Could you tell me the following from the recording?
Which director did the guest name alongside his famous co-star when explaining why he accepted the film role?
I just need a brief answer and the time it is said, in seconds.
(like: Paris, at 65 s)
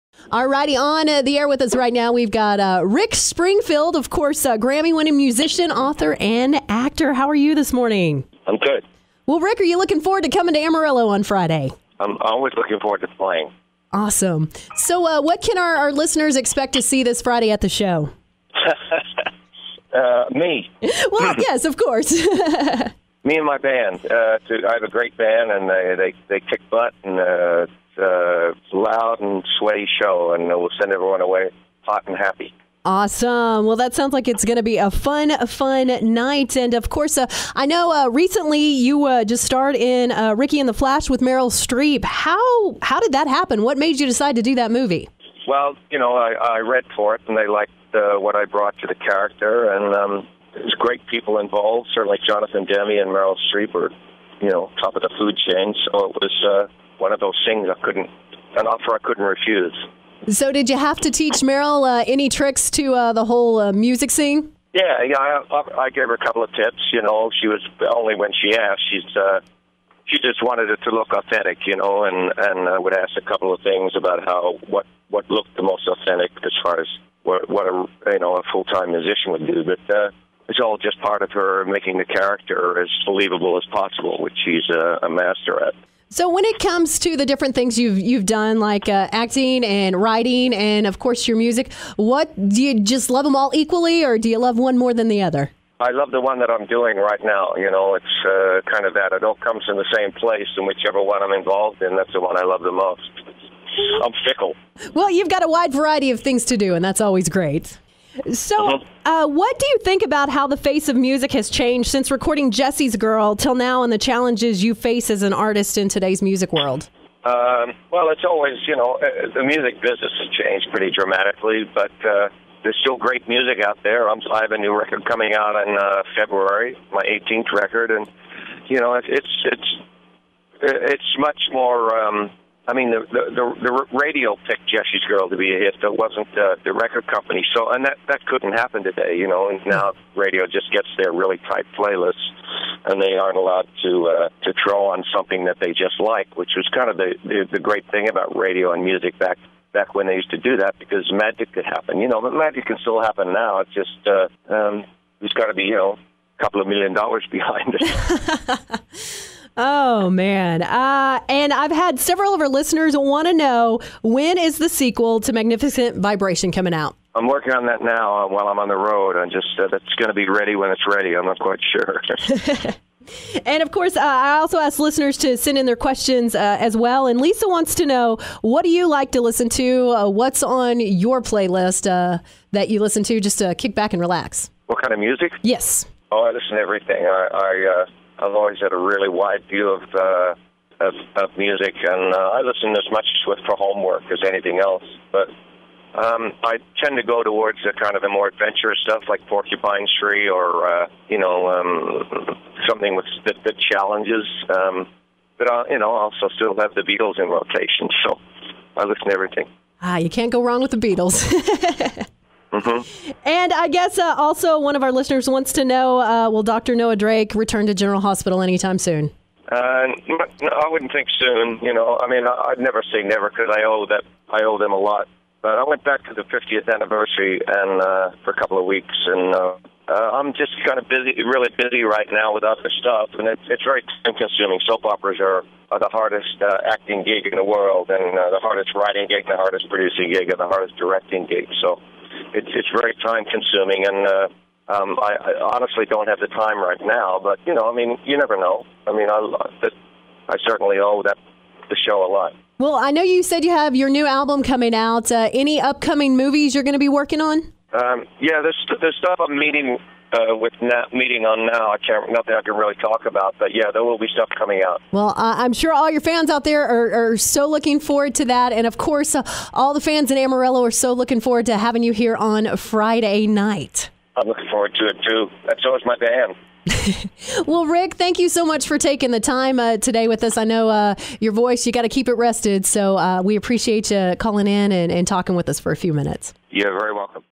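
Jonathan Demme, at 52 s.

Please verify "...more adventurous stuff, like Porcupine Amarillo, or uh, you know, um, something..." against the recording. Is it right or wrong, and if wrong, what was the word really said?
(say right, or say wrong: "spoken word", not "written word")
wrong: "Tree", not "Amarillo".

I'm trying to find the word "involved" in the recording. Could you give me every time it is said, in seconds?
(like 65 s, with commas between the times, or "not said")
51 s, 101 s.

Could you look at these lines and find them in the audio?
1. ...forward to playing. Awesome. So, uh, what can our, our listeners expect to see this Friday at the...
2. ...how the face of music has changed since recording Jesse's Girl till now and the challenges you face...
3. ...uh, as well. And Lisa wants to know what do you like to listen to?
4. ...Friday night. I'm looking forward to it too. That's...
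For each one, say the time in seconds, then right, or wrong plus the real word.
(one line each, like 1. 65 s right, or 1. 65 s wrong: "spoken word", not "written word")
1. 12 s right
2. 110 s right
3. 176 s right
4. 272 s right.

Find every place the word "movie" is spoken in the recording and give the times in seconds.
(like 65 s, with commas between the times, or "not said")
44 s, 256 s.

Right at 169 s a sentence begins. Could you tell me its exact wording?
I just uh, that's going to be ready when it's ready.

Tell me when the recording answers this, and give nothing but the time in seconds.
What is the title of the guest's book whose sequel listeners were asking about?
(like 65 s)
165 s.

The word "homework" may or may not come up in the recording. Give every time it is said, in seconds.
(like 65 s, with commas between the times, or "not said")
193 s.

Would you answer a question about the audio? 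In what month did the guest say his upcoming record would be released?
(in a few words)
February.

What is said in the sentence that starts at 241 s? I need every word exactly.
So it's it's very time consuming, and uh, um, I, I honestly don't have the time right now.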